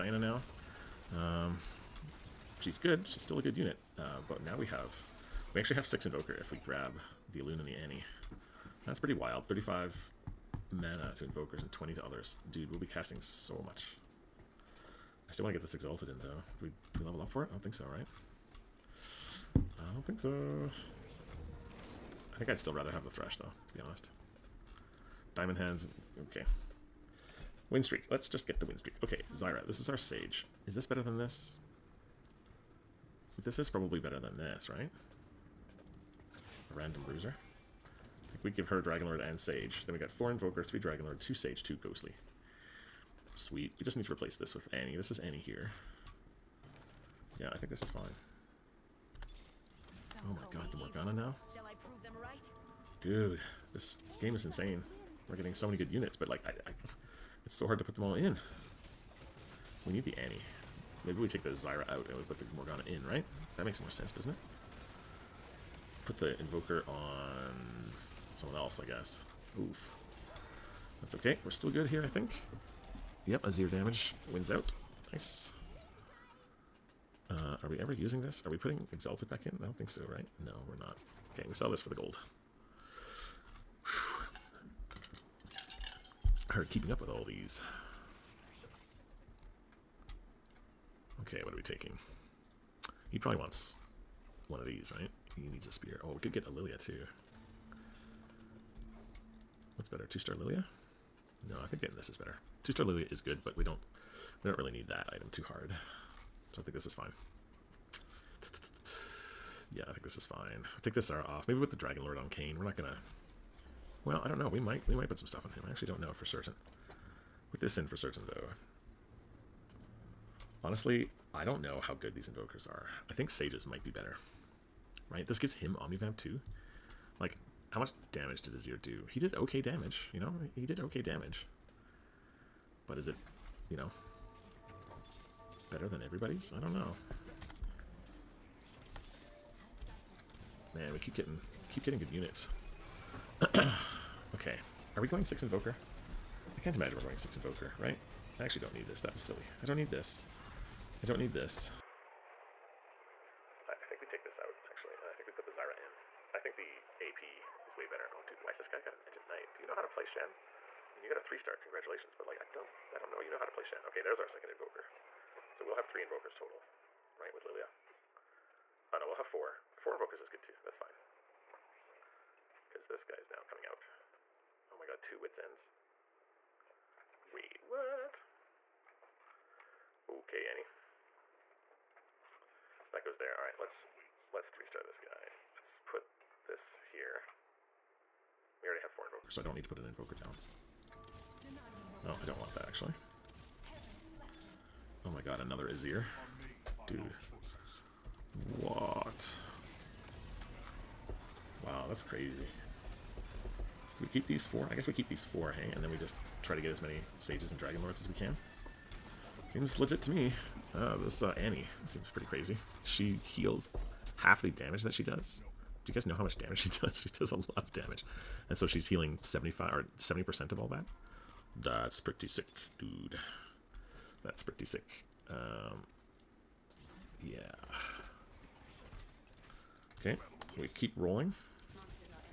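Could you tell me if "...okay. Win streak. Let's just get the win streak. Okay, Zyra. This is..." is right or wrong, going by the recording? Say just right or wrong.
right.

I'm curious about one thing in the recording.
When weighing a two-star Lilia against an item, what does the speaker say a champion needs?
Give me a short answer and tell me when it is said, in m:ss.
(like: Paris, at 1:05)
A spear, at 1:35.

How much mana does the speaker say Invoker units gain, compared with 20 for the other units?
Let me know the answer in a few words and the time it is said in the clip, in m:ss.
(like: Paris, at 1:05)
35, at 0:09.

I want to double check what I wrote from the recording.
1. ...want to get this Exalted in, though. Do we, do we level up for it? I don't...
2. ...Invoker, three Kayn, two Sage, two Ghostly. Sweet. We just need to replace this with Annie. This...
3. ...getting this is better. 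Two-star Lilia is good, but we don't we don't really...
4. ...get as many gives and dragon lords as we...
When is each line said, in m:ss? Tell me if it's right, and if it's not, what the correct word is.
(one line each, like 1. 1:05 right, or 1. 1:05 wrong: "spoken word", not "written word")
1. 0:15 right
2. 0:40 wrong: "Dragonlord", not "Kayn"
3. 1:41 right
4. 3:26 wrong: "sages", not "gives".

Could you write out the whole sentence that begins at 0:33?
This is probably better than this, right?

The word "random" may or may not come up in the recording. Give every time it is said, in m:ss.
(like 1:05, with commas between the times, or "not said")
0:36.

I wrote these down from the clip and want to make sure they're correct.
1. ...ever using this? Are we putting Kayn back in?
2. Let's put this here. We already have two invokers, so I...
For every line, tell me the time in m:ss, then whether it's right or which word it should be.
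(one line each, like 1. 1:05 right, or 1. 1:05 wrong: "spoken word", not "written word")
1. 1:17 wrong: "Exalted", not "Kayn"
2. 3:05 wrong: "four", not "two".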